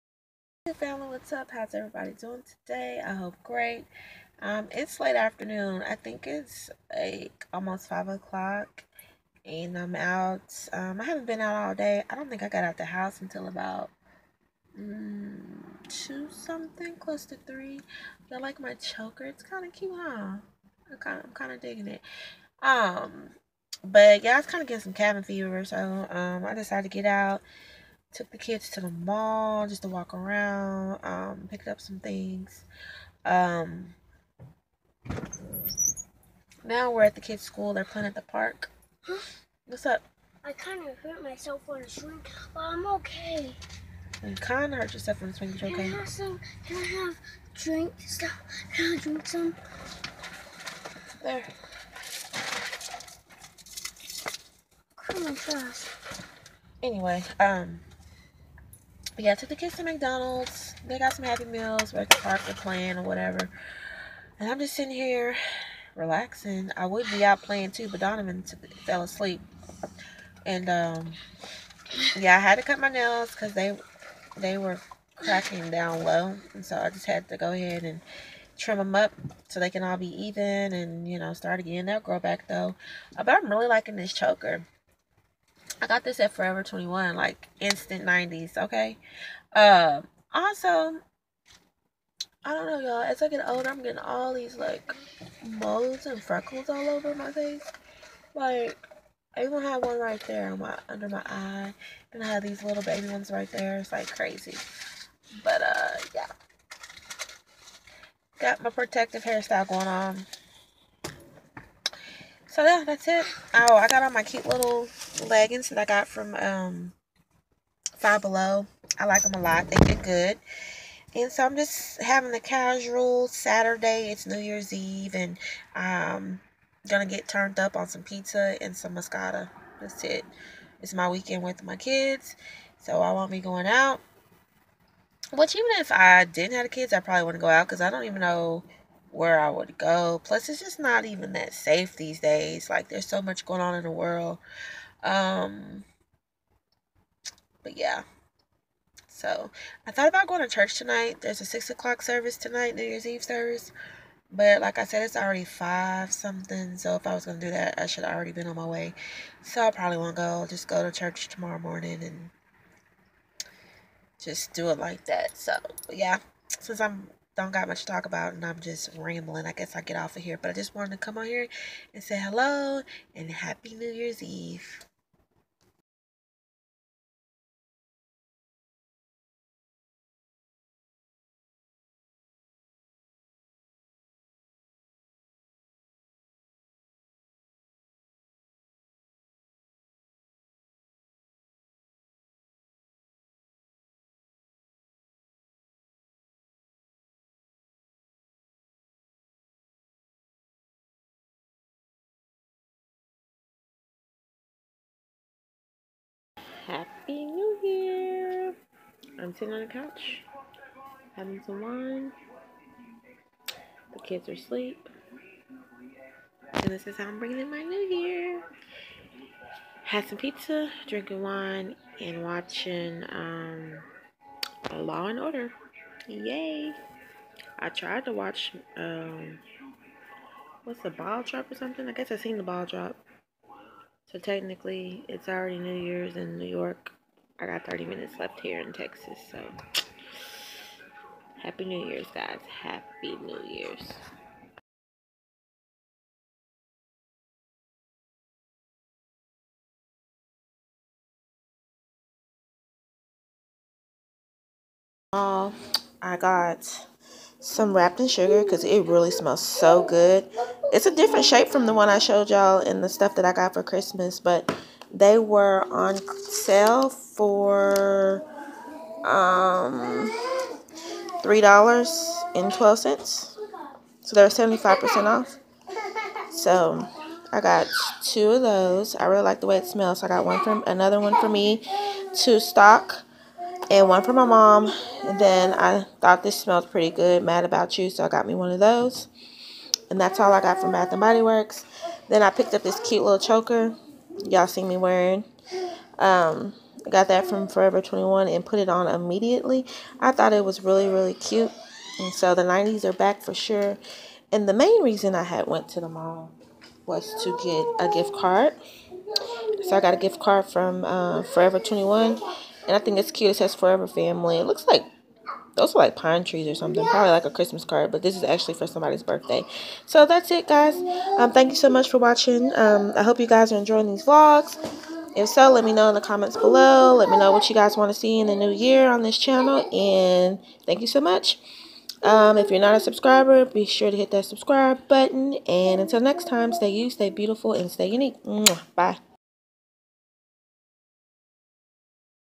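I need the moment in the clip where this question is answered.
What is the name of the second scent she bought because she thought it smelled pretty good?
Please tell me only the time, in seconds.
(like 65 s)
287 s.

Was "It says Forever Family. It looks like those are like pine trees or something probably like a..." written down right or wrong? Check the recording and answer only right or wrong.
right.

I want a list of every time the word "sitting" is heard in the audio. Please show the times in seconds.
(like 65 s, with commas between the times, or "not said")
64 s, 209 s.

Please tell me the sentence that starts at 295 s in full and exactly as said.
Um, I got that from Forever 21 and put it on immediately.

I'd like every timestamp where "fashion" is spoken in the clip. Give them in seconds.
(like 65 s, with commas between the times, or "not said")
not said.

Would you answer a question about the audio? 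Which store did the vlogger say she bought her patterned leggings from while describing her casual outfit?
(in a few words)
Five Below.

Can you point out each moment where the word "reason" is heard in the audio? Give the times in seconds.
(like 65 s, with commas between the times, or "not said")
304 s.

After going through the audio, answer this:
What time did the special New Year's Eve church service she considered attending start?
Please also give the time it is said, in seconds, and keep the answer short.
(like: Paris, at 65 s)
6 o'clock, at 151 s.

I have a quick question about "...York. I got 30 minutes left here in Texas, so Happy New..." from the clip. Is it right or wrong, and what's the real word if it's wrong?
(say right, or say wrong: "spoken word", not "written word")
right.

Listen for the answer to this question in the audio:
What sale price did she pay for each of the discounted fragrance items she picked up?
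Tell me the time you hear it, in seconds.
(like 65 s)
271 s.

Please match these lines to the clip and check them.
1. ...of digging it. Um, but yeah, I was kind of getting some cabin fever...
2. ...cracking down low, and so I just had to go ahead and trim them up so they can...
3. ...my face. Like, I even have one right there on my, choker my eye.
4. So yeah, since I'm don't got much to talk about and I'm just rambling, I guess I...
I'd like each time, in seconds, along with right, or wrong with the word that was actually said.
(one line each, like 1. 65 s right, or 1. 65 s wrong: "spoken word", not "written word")
1. 21 s right
2. 75 s right
3. 97 s wrong: "under", not "choker"
4. 165 s right.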